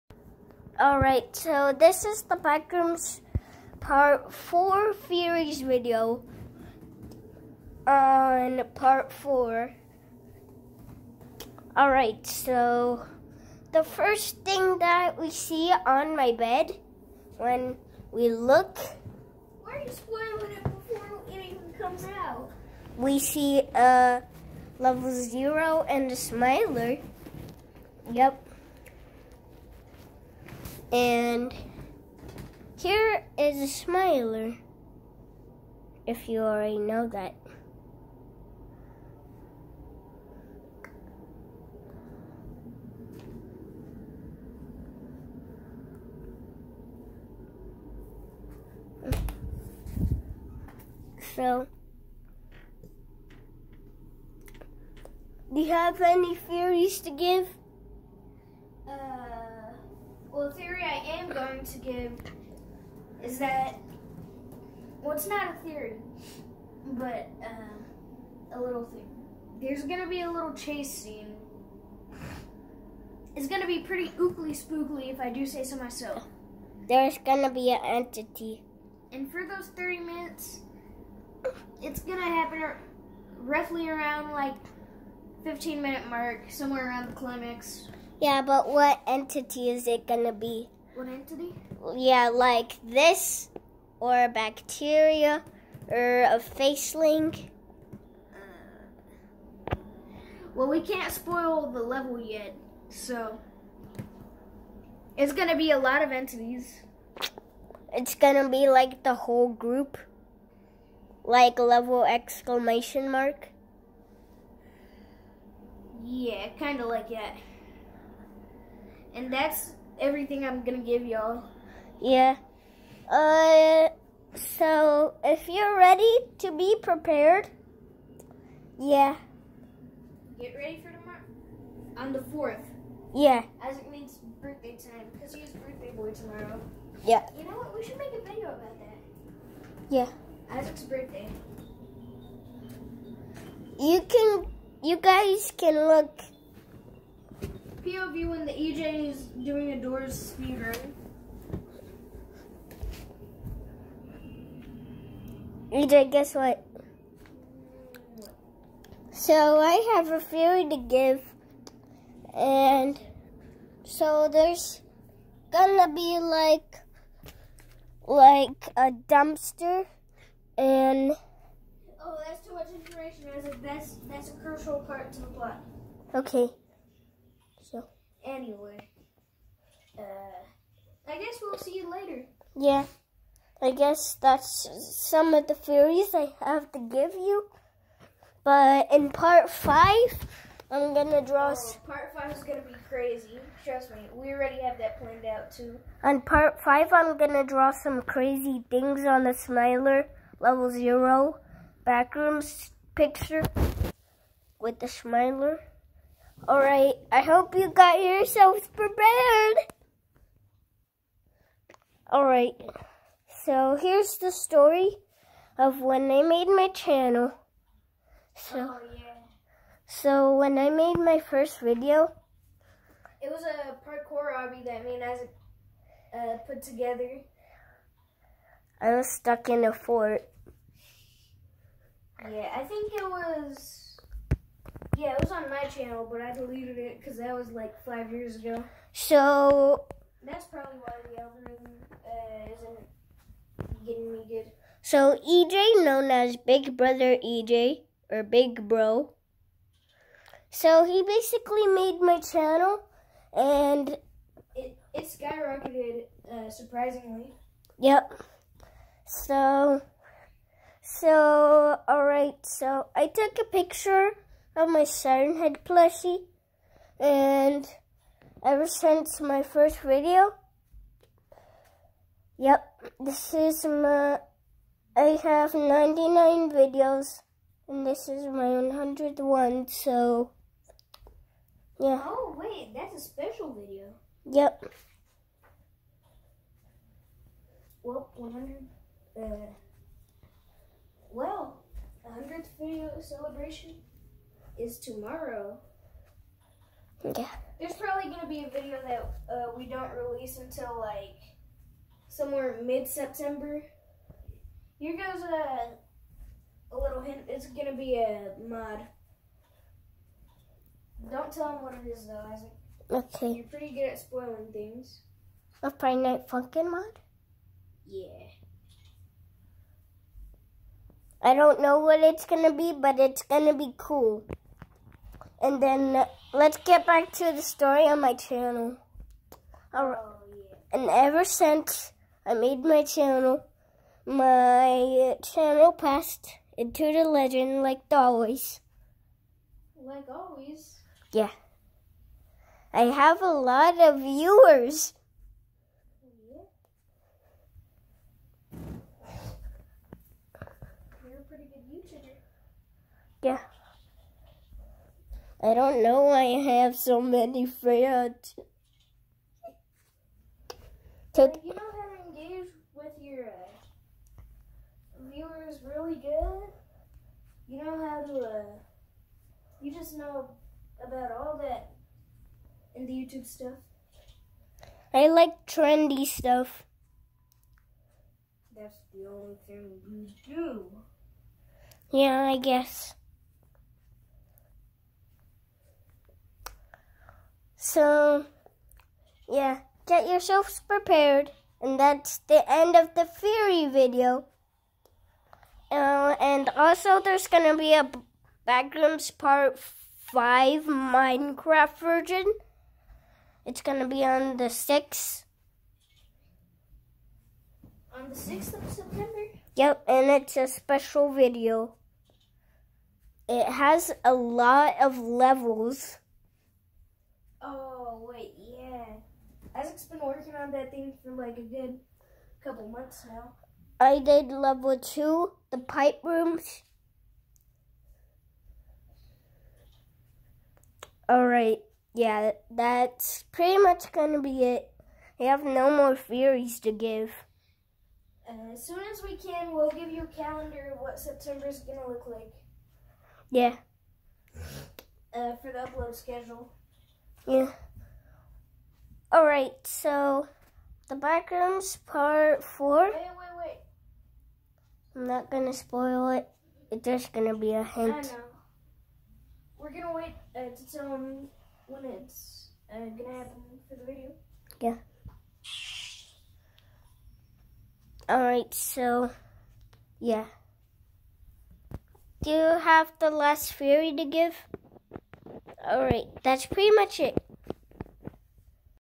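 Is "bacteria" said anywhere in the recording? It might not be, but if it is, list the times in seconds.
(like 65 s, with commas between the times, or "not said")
94 s.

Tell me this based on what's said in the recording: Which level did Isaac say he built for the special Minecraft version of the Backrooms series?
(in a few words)
level two, the pipe rooms.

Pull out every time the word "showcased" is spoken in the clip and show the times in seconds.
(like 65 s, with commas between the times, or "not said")
not said.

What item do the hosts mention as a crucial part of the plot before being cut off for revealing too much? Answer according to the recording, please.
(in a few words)
a dumpster.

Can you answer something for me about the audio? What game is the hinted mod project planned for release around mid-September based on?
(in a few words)
Friday Night Funkin'.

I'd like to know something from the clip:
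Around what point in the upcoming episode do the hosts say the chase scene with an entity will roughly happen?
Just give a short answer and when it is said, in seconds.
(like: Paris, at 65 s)
15 minute mark, at 85 s.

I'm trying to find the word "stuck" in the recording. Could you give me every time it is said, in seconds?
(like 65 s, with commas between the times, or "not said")
229 s.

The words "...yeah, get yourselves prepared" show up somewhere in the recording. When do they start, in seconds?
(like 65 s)
389 s.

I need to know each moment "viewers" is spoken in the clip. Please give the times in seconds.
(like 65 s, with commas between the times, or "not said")
343 s, 365 s.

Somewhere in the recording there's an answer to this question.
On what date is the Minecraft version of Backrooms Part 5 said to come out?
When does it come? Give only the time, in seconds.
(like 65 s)
408 s.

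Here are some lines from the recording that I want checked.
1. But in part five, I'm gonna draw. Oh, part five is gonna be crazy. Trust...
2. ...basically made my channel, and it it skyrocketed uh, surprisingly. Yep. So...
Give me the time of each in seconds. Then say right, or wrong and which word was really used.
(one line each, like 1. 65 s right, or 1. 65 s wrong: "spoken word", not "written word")
1. 188 s right
2. 251 s right.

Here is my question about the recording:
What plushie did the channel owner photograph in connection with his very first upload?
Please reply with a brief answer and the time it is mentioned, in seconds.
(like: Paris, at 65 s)
Siren Head, at 264 s.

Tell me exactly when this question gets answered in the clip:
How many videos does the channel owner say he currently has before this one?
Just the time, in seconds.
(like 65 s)
275 s.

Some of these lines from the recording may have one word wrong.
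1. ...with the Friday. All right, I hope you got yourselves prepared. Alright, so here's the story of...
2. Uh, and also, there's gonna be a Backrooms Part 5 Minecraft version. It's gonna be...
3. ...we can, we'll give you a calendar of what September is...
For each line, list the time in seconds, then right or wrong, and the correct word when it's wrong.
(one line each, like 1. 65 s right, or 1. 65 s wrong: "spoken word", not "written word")
1. 204 s wrong: "Smiler", not "Friday"
2. 395 s right
3. 439 s right.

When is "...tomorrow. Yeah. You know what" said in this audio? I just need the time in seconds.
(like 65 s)
136 s.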